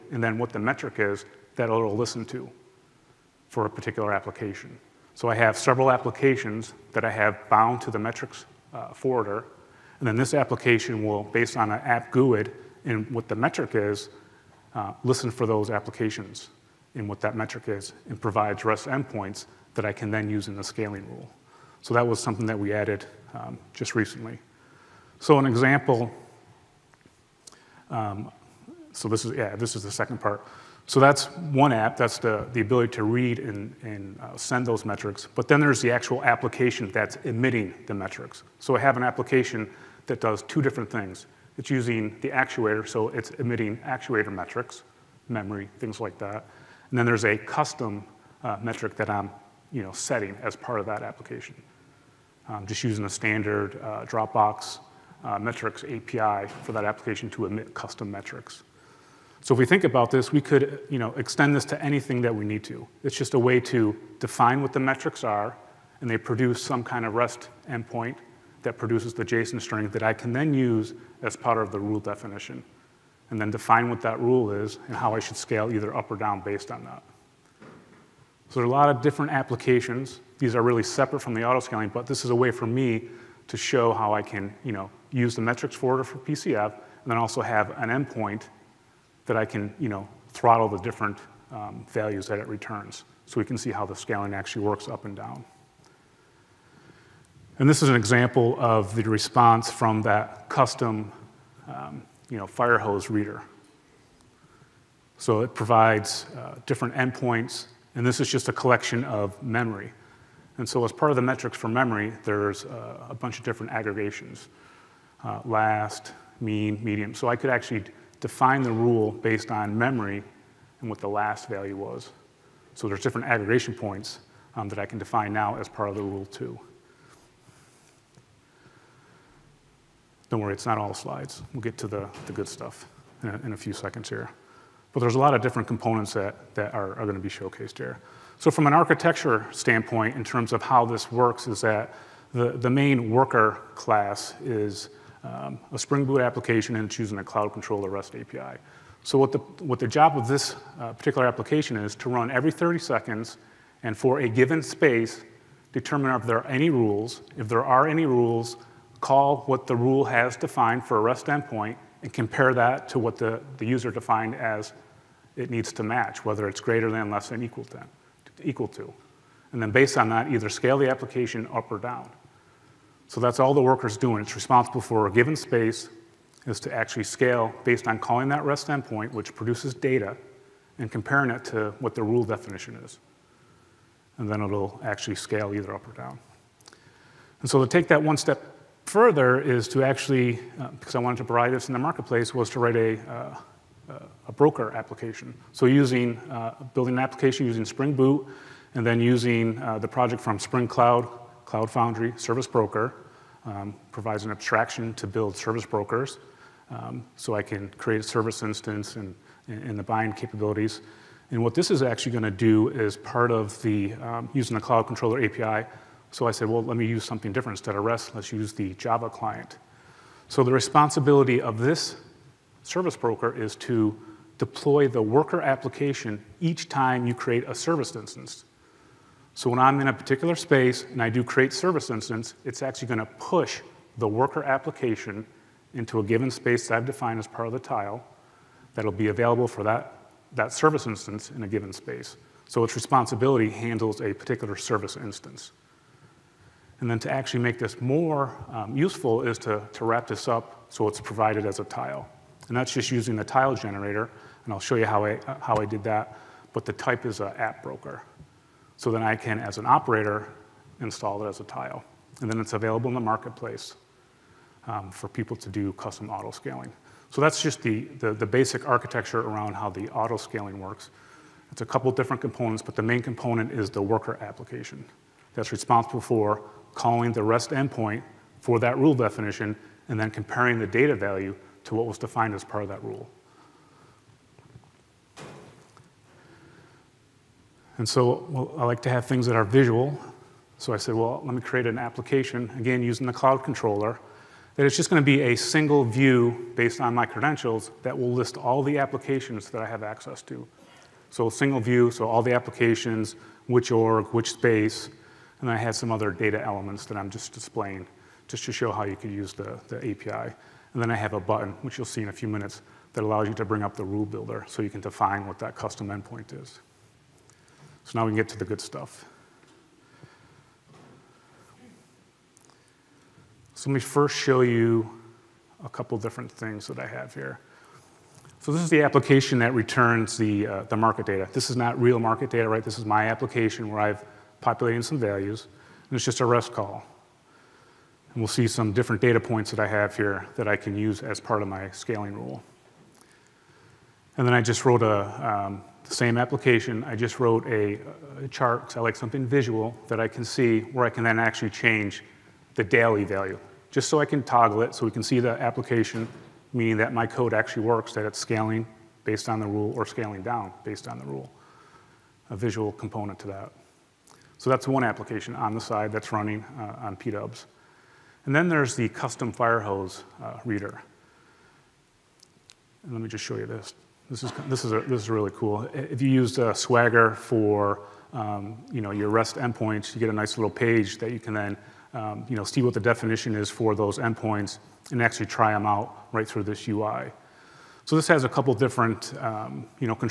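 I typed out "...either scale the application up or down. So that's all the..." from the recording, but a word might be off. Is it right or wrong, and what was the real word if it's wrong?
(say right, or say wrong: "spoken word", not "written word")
right.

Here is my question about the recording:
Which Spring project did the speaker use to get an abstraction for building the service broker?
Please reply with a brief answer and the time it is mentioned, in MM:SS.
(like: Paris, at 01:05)
Spring Cloud Cloud Foundry Service Broker, at 03:20.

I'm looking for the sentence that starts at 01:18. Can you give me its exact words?
So there are a lot of different applications.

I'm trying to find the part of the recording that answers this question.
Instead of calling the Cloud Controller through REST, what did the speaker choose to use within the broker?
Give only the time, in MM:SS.
03:38.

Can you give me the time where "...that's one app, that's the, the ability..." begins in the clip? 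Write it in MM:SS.
00:30.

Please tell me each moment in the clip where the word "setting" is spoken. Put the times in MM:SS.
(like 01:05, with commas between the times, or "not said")
00:49.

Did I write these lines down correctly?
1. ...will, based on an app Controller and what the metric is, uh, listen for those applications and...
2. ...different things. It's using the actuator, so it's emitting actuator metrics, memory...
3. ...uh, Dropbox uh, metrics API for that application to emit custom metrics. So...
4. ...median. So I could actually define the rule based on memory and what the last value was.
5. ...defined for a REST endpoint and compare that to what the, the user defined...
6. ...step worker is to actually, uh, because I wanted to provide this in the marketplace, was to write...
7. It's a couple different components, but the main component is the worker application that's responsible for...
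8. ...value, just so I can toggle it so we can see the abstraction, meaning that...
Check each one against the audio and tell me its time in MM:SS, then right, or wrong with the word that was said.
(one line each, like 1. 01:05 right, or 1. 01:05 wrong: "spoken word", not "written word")
1. 00:11 wrong: "GUID", not "Controller"
2. 00:40 right
3. 00:53 right
4. 01:56 right
5. 02:40 right
6. 03:08 wrong: "further", not "worker"
7. 04:31 right
8. 05:53 wrong: "application", not "abstraction".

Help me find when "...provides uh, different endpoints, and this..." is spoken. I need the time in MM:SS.
01:45.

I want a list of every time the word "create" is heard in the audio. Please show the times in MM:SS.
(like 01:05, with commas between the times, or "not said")
03:27, 03:47, 03:51, 04:51.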